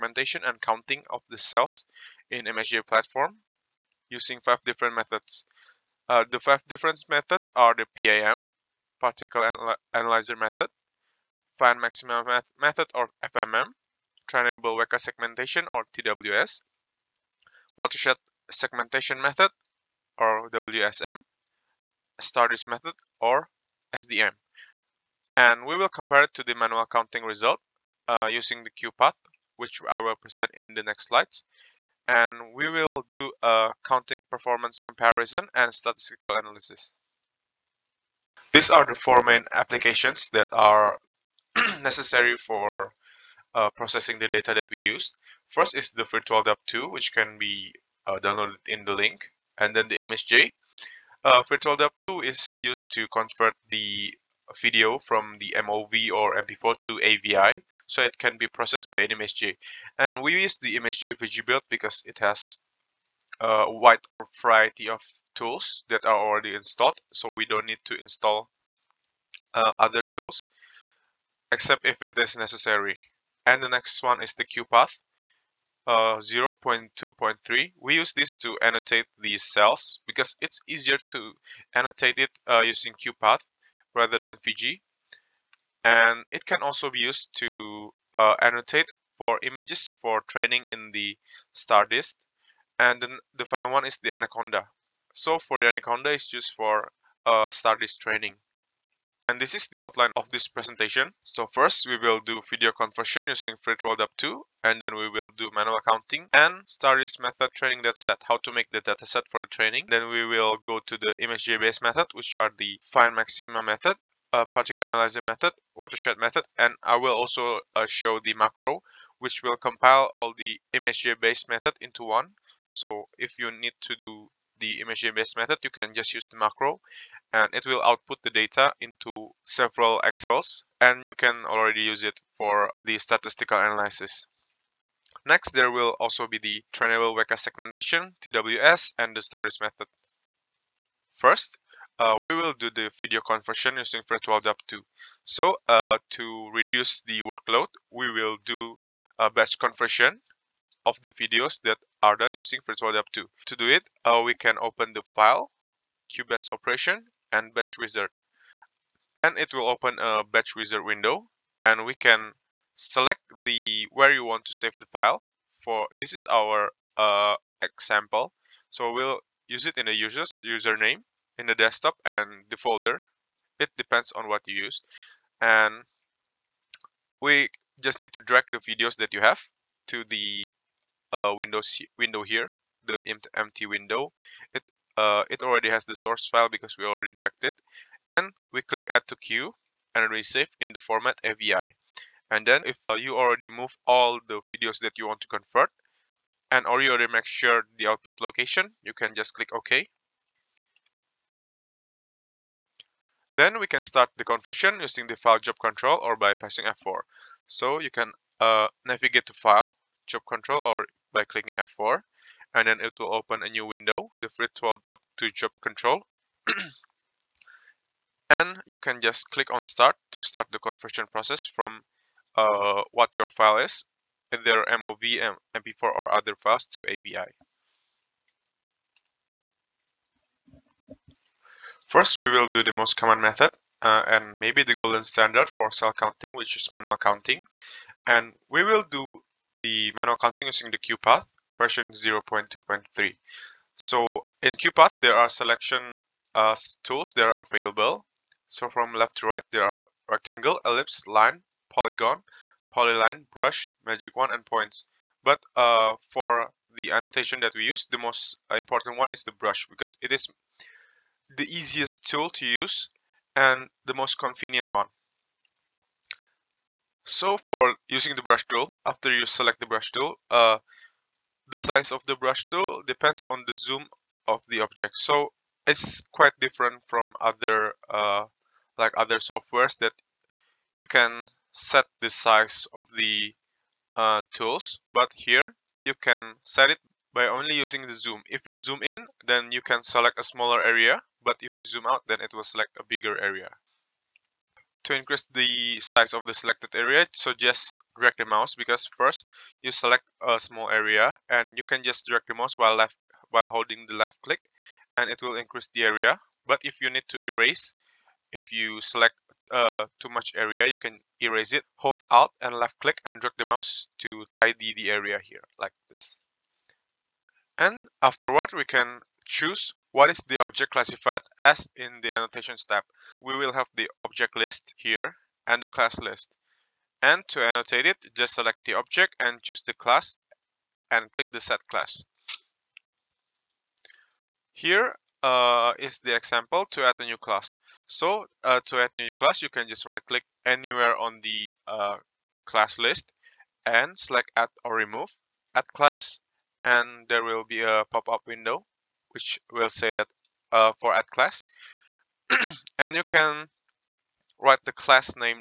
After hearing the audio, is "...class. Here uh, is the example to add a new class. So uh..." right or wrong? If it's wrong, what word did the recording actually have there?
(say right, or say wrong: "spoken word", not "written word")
right.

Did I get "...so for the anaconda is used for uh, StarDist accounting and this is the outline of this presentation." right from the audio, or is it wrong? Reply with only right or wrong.
wrong.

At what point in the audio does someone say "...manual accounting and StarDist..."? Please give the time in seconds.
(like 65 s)
105 s.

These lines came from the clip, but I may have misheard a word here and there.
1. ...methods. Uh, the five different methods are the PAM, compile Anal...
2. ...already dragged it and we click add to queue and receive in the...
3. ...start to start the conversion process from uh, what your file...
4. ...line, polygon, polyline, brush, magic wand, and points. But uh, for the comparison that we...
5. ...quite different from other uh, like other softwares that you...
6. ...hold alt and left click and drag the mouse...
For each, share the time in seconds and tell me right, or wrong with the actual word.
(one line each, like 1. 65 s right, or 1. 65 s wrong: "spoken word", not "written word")
1. 4 s wrong: "particle", not "compile"
2. 186 s right
3. 219 s right
4. 251 s wrong: "annotation", not "comparison"
5. 276 s right
6. 311 s right.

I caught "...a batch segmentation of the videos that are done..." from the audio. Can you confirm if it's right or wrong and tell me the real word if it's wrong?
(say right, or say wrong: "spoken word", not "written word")
wrong: "conversion", not "segmentation".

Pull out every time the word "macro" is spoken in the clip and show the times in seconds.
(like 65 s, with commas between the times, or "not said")
118 s, 126 s.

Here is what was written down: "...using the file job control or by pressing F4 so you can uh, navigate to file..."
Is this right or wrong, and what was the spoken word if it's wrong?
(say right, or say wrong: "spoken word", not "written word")
right.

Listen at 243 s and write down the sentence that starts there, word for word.
So in QuPath, there are selection uh, tools that are available.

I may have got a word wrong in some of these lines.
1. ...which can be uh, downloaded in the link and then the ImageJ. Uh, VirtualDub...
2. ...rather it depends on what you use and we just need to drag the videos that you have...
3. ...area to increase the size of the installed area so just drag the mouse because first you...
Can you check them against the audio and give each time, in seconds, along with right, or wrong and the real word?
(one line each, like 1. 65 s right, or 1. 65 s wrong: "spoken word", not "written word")
1. 46 s right
2. 172 s wrong: "folder", not "rather"
3. 293 s wrong: "selected", not "installed".